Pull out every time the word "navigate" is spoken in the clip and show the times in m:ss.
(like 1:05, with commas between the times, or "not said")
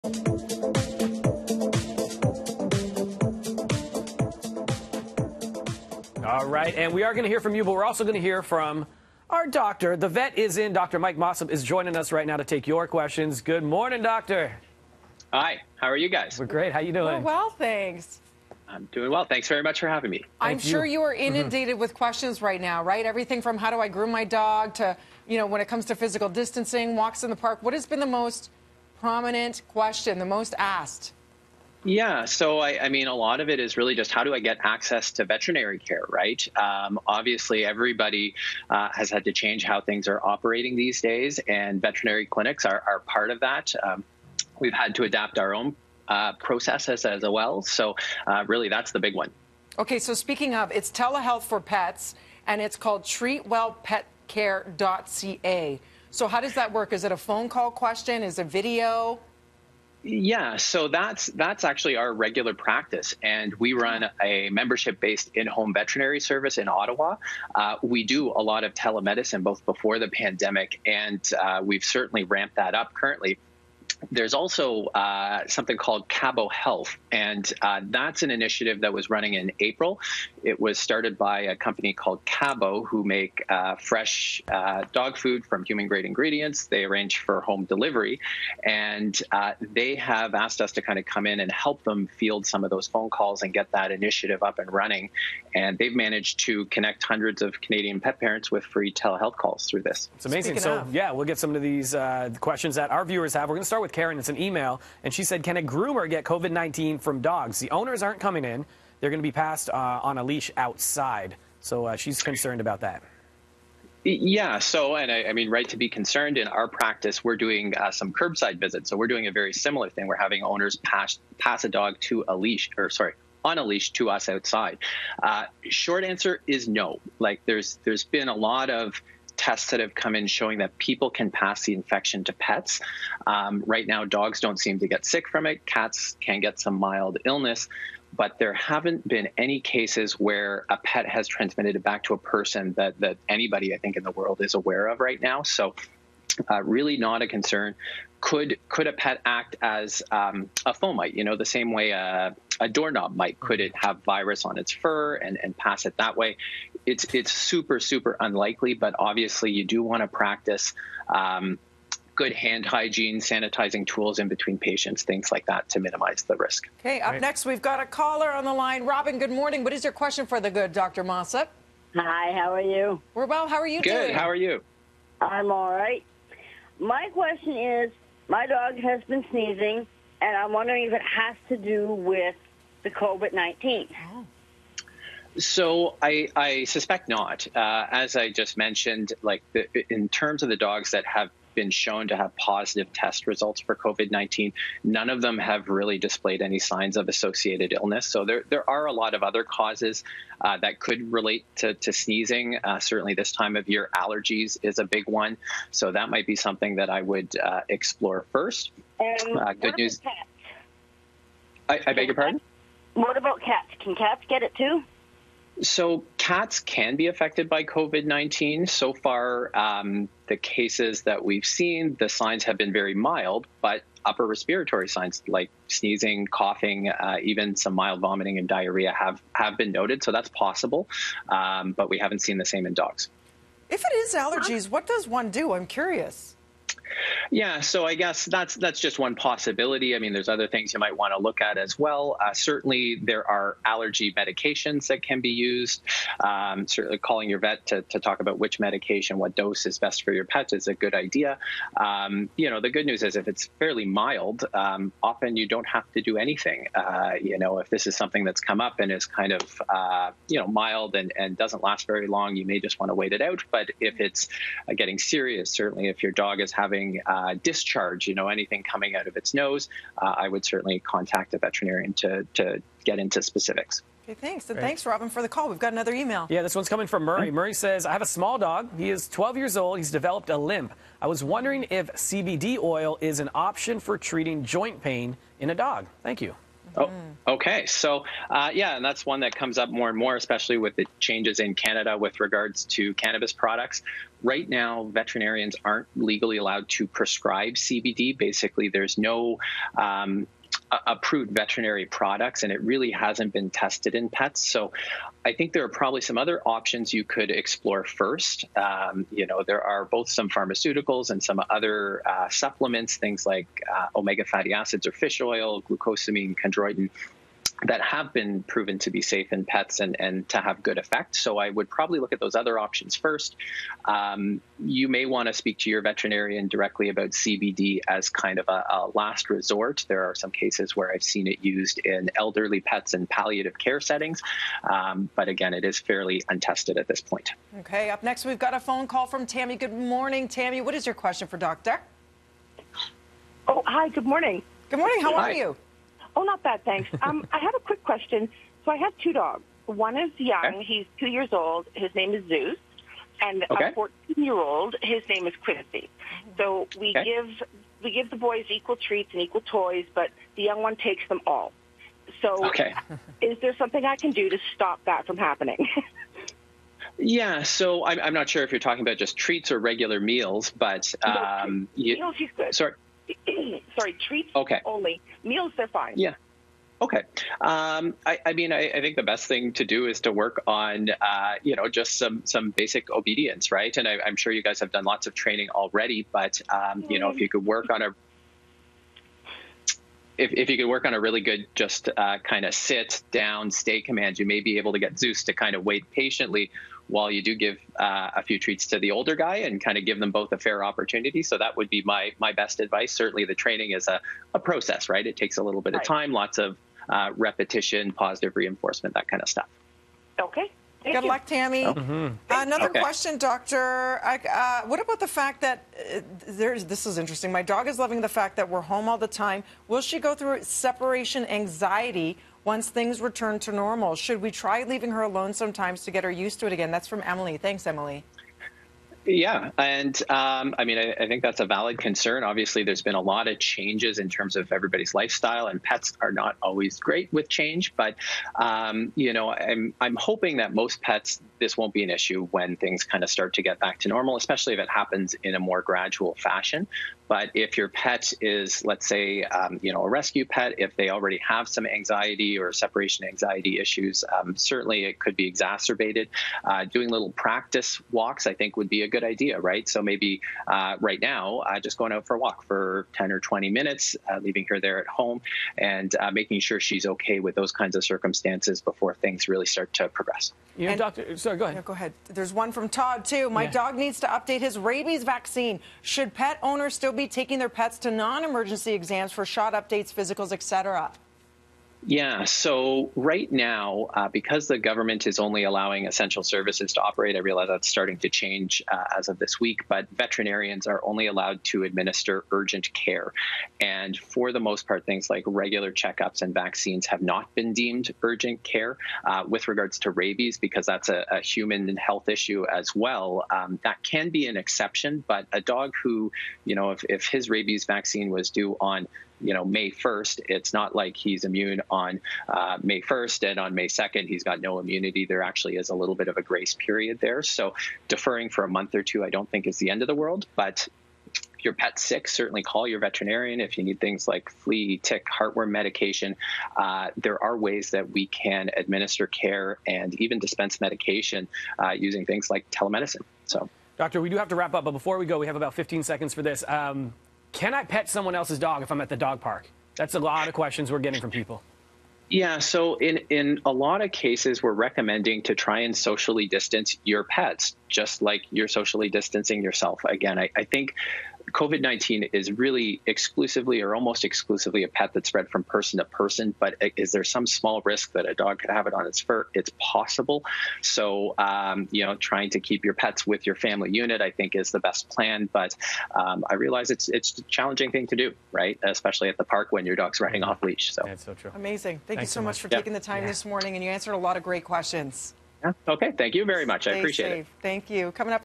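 not said.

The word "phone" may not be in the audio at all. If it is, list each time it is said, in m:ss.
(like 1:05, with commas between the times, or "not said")
0:57, 1:32, 5:38.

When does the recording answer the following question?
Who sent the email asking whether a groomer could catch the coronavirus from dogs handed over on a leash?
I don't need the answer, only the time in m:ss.
1:43.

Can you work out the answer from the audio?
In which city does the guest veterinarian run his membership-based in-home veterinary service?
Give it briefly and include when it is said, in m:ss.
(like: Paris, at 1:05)
Ottawa, at 1:06.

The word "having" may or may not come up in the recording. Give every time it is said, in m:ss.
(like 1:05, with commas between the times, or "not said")
0:19, 2:00, 4:26.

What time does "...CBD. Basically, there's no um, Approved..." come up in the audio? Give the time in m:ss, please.
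4:57.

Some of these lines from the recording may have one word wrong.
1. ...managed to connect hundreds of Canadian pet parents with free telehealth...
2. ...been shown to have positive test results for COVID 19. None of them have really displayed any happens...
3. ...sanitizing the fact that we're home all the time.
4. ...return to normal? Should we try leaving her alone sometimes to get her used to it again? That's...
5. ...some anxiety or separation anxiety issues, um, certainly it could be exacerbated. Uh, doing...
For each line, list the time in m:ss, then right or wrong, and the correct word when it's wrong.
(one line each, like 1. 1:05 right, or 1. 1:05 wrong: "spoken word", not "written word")
1. 1:35 right
2. 3:11 wrong: "signs", not "happens"
3. 6:57 wrong: "loving", not "sanitizing"
4. 7:03 right
5. 7:31 right.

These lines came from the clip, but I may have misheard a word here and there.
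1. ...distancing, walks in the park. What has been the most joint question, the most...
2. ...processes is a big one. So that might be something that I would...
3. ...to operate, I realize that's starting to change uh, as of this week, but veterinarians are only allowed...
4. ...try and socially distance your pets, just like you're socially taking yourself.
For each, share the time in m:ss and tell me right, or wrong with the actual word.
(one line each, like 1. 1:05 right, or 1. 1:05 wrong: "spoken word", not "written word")
1. 0:26 wrong: "prominent", not "joint"
2. 3:23 wrong: "allergies", not "processes"
3. 8:06 right
4. 9:05 wrong: "distancing", not "taking".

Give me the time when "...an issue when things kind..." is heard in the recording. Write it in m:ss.
7:21.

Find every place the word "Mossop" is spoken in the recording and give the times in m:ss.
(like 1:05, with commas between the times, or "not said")
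0:11, 2:51.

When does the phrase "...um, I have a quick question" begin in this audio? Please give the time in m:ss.
5:47.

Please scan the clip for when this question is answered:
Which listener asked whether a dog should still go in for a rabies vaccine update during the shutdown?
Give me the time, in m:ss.
7:52.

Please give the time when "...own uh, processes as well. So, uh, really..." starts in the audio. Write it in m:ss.
0:45.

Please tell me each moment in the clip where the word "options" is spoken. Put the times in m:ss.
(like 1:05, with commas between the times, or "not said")
4:43, 5:06, 5:22.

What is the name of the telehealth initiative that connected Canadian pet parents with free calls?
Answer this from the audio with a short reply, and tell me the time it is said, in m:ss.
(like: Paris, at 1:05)
Kabo Health, at 1:16.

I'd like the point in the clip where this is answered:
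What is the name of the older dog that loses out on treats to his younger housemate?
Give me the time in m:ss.
5:55.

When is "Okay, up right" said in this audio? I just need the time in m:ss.
2:46.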